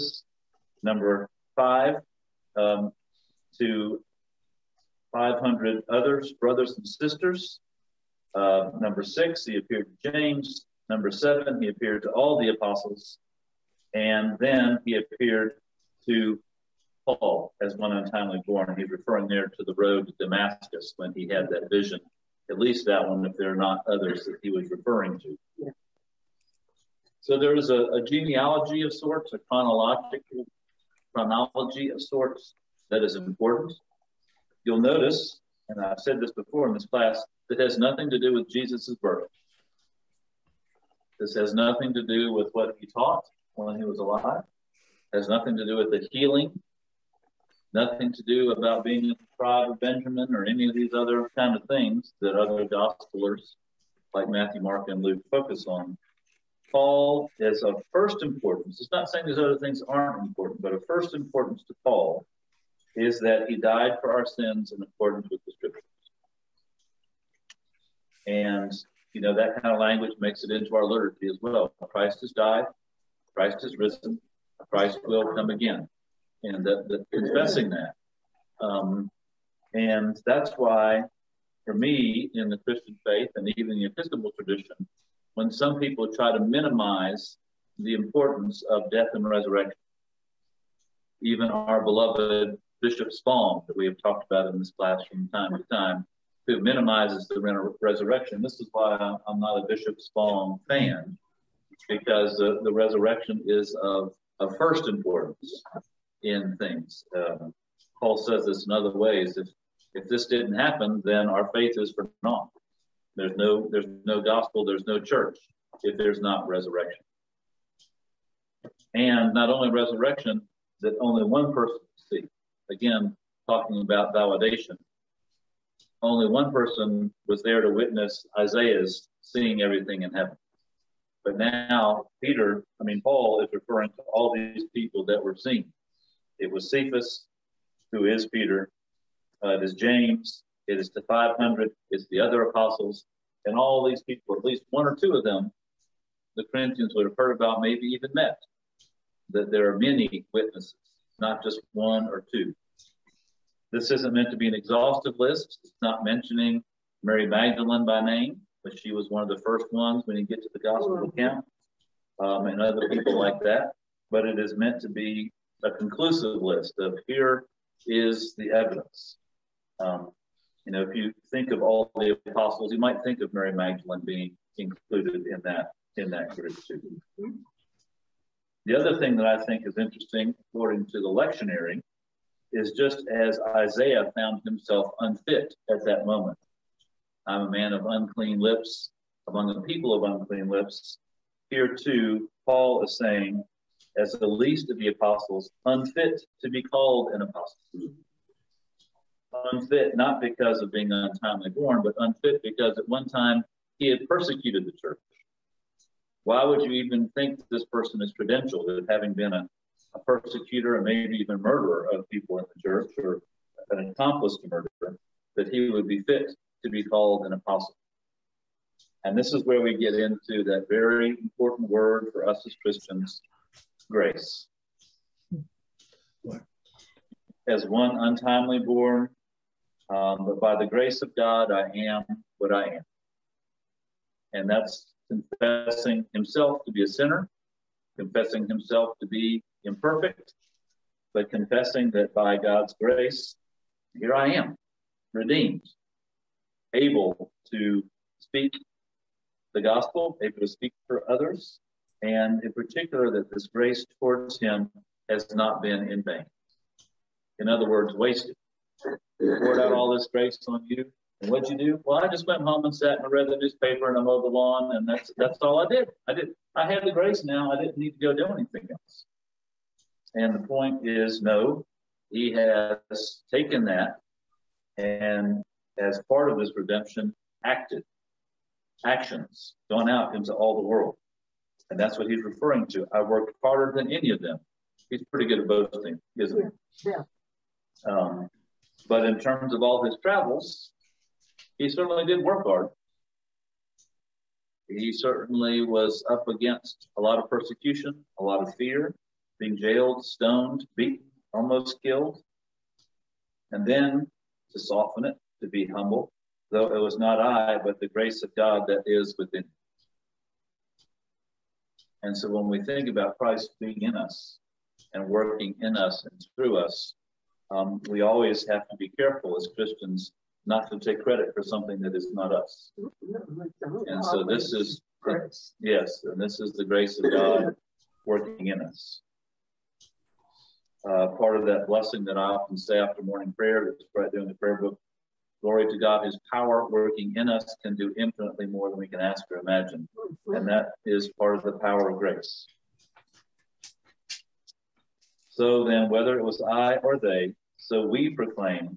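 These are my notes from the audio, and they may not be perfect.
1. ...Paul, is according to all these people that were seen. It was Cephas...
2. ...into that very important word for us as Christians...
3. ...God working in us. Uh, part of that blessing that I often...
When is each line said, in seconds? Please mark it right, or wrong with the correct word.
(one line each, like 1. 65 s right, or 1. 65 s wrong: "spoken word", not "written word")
1. 133 s wrong: "referring", not "according"
2. 219 s right
3. 327 s right.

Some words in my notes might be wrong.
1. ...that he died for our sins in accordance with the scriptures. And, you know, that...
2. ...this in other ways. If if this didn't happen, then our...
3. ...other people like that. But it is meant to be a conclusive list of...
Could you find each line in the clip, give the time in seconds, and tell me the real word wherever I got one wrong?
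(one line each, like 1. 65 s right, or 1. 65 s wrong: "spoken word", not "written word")
1. 63 s right
2. 108 s right
3. 162 s right.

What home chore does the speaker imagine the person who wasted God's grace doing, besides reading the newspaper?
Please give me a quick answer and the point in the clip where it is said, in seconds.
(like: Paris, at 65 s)
mowed the lawn, at 264 s.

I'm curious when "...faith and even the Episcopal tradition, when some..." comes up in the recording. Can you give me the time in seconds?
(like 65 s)
83 s.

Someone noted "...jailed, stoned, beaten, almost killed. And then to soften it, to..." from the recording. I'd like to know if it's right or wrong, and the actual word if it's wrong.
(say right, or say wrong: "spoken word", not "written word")
right.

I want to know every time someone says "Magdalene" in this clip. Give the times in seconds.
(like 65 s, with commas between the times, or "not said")
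157 s, 173 s.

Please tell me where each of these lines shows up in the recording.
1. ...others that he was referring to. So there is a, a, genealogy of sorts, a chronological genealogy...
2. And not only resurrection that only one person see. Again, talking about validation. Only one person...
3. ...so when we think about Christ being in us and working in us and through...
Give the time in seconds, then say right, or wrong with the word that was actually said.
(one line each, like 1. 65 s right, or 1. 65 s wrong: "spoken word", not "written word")
1. 23 s wrong: "chronology", not "genealogy"
2. 118 s right
3. 312 s right.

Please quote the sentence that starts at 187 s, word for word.
I'm a man of unclean lips, among the people of unclean lips.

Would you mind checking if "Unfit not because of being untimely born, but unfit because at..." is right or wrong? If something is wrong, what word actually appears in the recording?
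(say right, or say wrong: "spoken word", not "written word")
right.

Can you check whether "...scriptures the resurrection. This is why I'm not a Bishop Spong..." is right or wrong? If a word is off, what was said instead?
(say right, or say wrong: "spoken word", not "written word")
wrong: "minimizes", not "scriptures".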